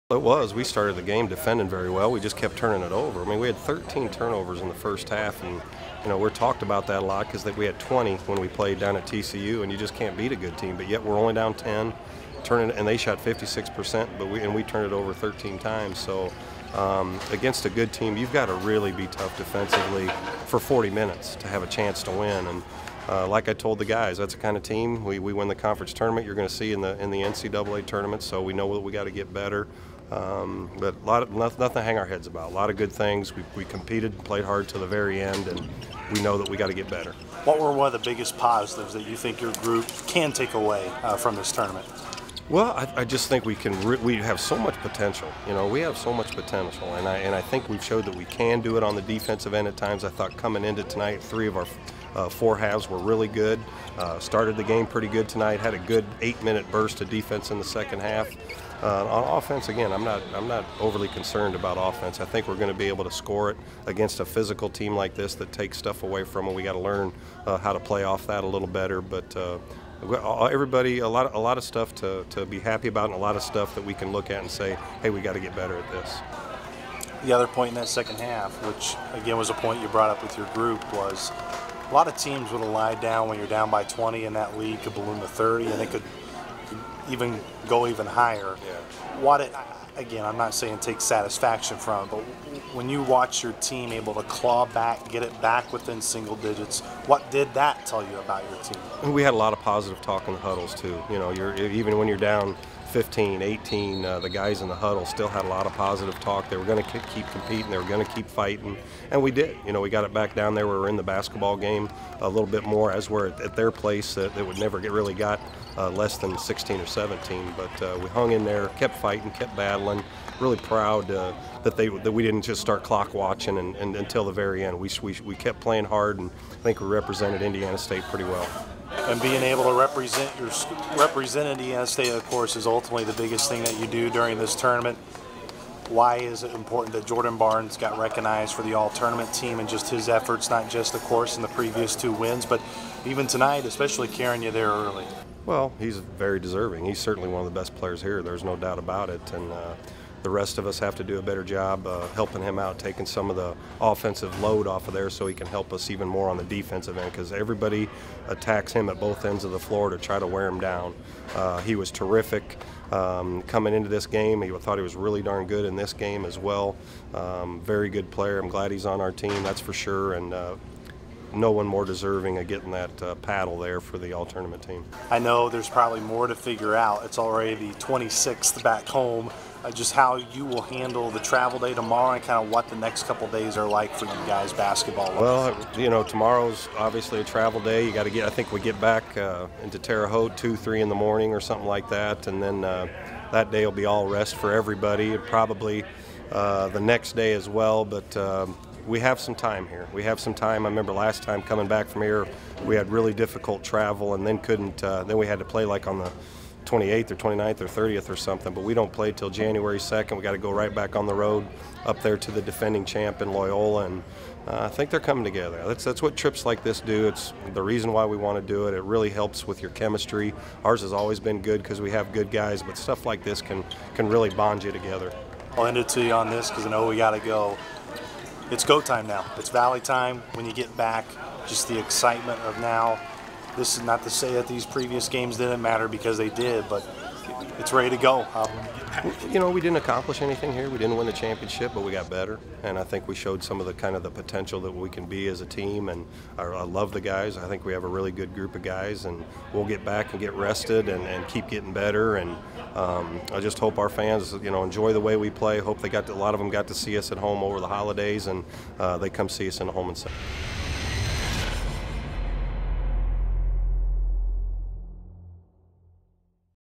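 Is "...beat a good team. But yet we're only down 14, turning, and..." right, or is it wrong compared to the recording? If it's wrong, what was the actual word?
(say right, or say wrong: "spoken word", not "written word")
wrong: "10", not "14".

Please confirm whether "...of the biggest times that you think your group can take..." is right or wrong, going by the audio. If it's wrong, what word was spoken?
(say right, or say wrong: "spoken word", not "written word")
wrong: "positives", not "times".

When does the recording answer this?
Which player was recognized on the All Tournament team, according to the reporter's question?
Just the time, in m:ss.
2:17.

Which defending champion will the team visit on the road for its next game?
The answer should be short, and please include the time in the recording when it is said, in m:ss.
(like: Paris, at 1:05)
Loyola, at 3:33.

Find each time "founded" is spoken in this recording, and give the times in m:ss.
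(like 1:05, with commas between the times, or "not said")
not said.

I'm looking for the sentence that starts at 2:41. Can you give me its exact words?
Uh, he was terrific um, coming into this game.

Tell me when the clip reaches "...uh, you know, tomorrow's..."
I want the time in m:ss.
3:05.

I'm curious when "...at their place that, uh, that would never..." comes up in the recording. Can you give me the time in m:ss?
1:53.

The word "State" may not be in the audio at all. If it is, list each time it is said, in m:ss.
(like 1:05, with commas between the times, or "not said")
2:07, 2:11.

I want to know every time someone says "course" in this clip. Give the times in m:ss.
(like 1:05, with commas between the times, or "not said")
2:12, 2:20.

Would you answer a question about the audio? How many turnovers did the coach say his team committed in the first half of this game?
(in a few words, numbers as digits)
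13.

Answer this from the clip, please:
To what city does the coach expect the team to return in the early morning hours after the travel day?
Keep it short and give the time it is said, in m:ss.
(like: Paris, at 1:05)
Terre Haute, at 3:09.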